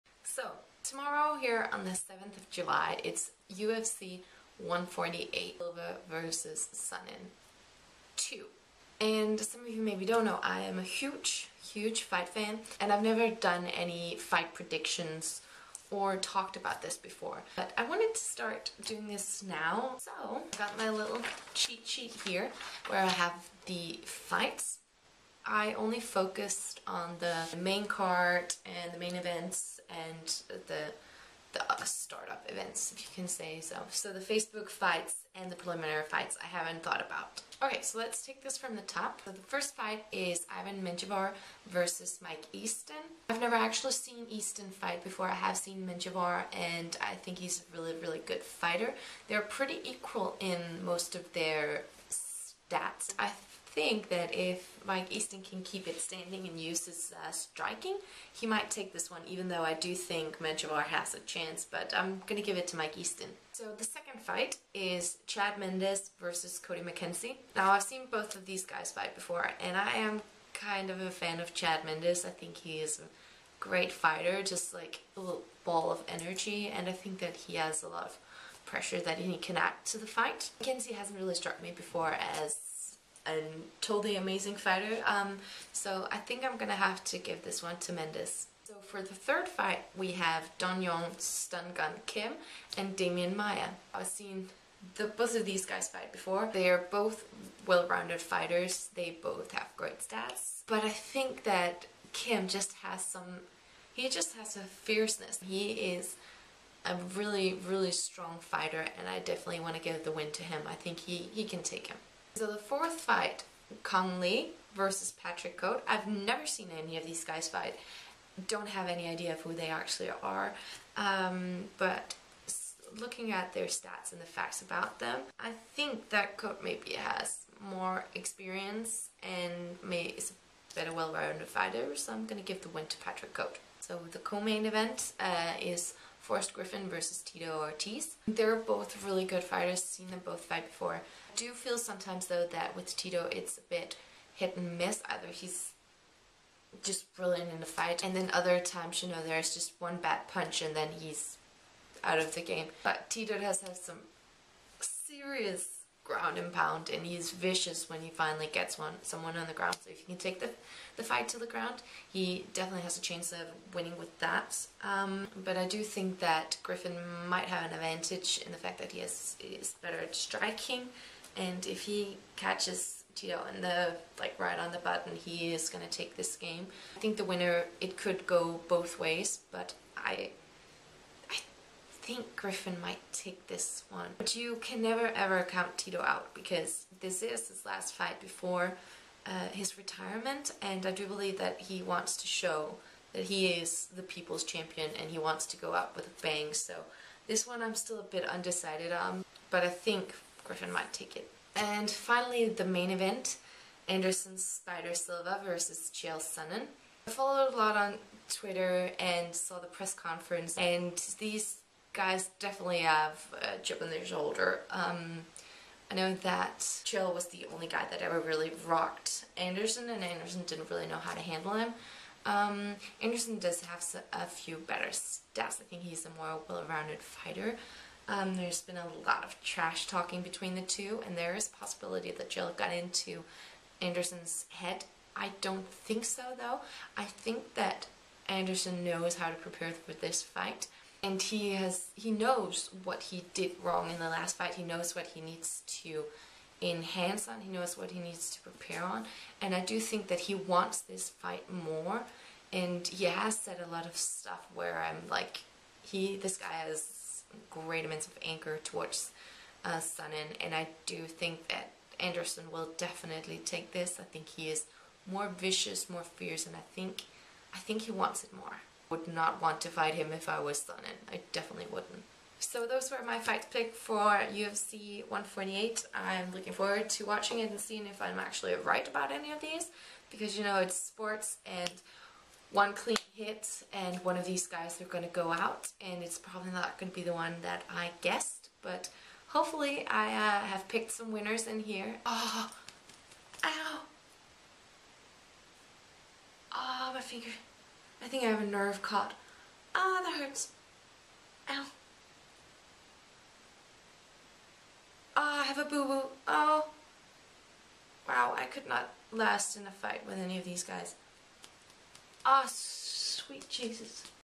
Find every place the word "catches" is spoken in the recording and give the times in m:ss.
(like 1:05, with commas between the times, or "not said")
2:52.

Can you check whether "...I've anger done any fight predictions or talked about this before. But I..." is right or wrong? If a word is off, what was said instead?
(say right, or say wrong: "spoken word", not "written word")
wrong: "never", not "anger".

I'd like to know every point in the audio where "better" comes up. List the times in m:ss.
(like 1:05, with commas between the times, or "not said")
2:10, 2:49, 3:44.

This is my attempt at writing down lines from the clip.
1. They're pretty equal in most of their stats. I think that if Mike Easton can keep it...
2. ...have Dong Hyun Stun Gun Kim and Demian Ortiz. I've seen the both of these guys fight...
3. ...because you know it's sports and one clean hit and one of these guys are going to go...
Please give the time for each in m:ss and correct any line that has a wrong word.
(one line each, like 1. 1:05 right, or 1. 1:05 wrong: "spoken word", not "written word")
1. 0:49 right
2. 1:30 wrong: "Maia", not "Ortiz"
3. 4:40 right.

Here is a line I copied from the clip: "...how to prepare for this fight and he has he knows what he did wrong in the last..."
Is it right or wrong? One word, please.
right.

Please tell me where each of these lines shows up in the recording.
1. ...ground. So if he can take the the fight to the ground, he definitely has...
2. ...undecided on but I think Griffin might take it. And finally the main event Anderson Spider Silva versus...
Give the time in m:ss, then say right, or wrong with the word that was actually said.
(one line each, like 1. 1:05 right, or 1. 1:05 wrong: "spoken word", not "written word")
1. 2:39 right
2. 3:18 right.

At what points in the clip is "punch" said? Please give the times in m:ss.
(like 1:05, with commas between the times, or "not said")
2:30.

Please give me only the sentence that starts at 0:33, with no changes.
So the Facebook fights and the preliminary fights I haven't thought about.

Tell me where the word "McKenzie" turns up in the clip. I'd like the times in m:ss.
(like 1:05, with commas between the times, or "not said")
1:06, 1:20.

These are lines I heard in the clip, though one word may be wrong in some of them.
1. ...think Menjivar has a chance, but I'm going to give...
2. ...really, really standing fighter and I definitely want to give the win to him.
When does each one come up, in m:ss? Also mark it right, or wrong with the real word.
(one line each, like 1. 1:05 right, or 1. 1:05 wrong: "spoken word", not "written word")
1. 0:59 right
2. 1:47 wrong: "strong", not "standing".